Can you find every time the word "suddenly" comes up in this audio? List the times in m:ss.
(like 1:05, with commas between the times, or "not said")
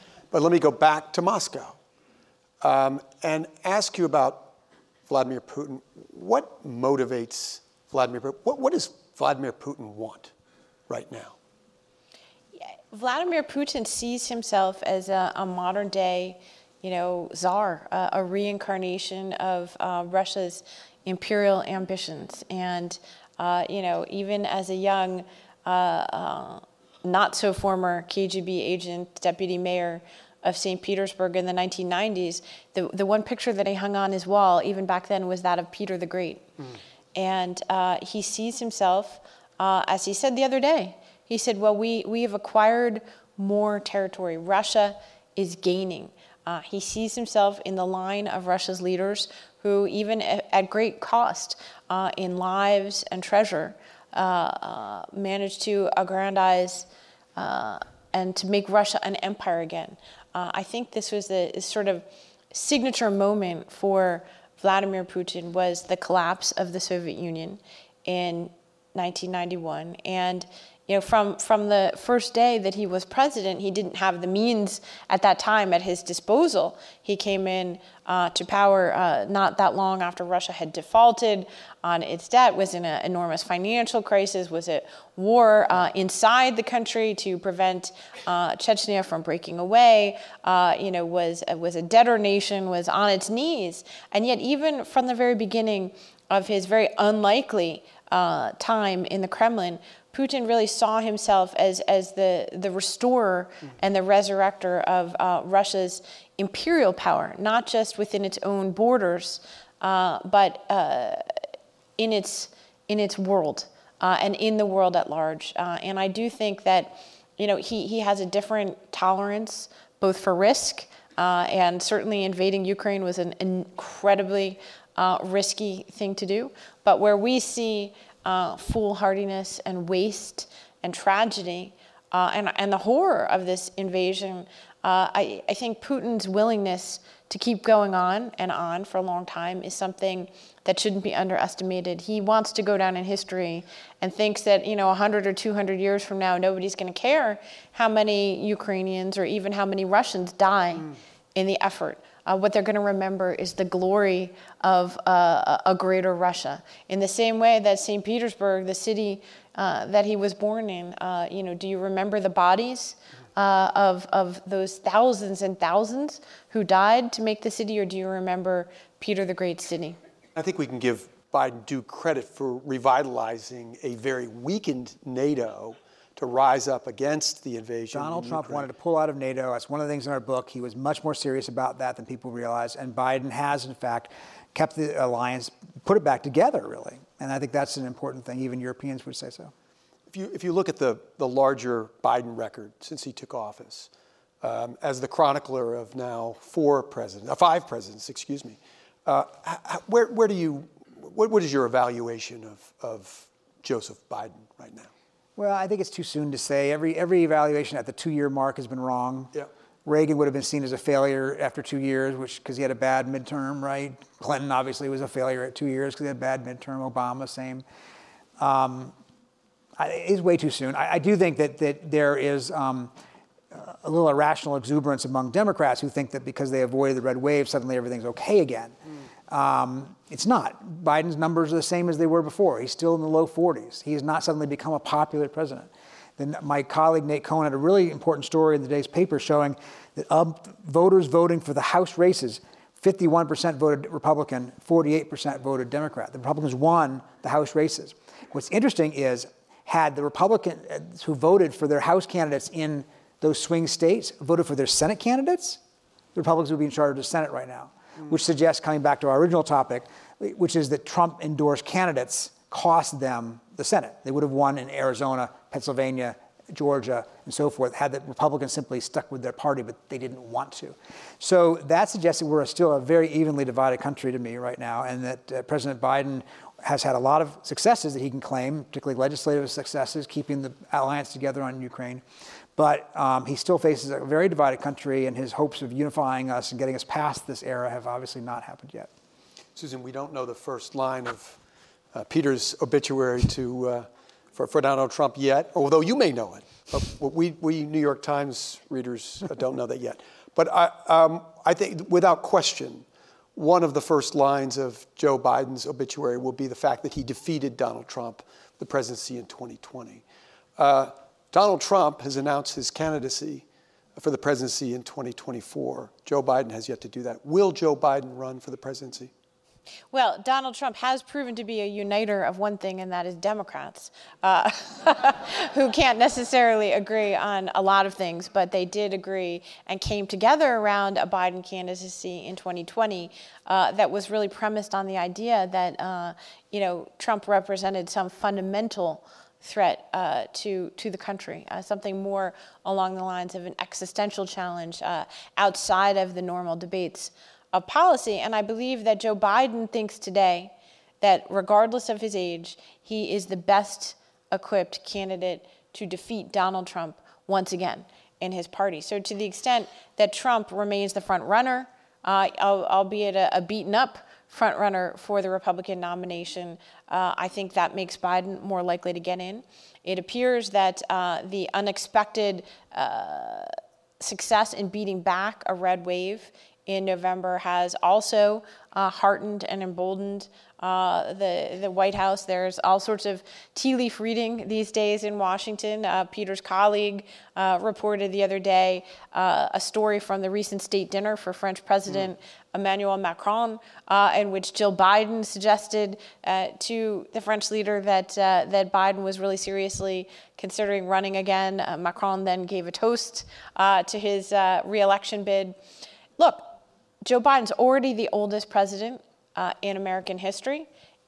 3:47, 3:54.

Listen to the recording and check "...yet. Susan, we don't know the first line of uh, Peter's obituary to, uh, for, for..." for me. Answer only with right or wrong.
right.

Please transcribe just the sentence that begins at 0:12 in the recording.
Vladimir Putin sees himself as a, a modern day, you know, czar, uh, a reincarnation of uh, Russia's imperial ambitions.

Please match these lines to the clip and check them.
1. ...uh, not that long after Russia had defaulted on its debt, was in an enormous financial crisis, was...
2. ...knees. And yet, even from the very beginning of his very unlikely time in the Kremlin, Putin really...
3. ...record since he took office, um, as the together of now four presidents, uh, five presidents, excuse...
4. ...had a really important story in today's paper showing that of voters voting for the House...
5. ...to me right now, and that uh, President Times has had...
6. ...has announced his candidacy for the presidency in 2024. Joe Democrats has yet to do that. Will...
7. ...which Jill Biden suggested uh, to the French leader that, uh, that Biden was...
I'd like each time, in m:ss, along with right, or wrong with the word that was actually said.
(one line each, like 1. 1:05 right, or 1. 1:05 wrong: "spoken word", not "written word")
1. 1:18 right
2. 1:33 right
3. 3:12 wrong: "chronicler", not "together"
4. 3:57 right
5. 4:34 wrong: "Biden", not "Times"
6. 5:12 wrong: "Biden", not "Democrats"
7. 6:34 right.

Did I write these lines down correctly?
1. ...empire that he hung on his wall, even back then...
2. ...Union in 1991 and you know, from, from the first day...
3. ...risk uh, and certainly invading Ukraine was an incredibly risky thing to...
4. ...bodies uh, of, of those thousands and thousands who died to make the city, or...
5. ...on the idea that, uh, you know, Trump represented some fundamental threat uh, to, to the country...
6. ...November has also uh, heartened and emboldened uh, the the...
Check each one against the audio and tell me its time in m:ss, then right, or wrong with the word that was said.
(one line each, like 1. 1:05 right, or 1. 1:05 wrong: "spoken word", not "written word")
1. 0:33 wrong: "picture", not "empire"
2. 1:07 right
3. 2:00 right
4. 2:42 right
5. 5:34 right
6. 6:16 right.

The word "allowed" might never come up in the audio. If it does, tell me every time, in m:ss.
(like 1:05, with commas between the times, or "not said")
not said.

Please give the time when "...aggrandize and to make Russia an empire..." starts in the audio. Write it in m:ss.
0:55.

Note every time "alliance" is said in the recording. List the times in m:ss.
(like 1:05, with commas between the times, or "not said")
3:05, 4:40.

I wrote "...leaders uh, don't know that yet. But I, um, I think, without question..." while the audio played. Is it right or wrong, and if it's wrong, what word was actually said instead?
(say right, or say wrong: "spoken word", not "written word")
wrong: "readers", not "leaders".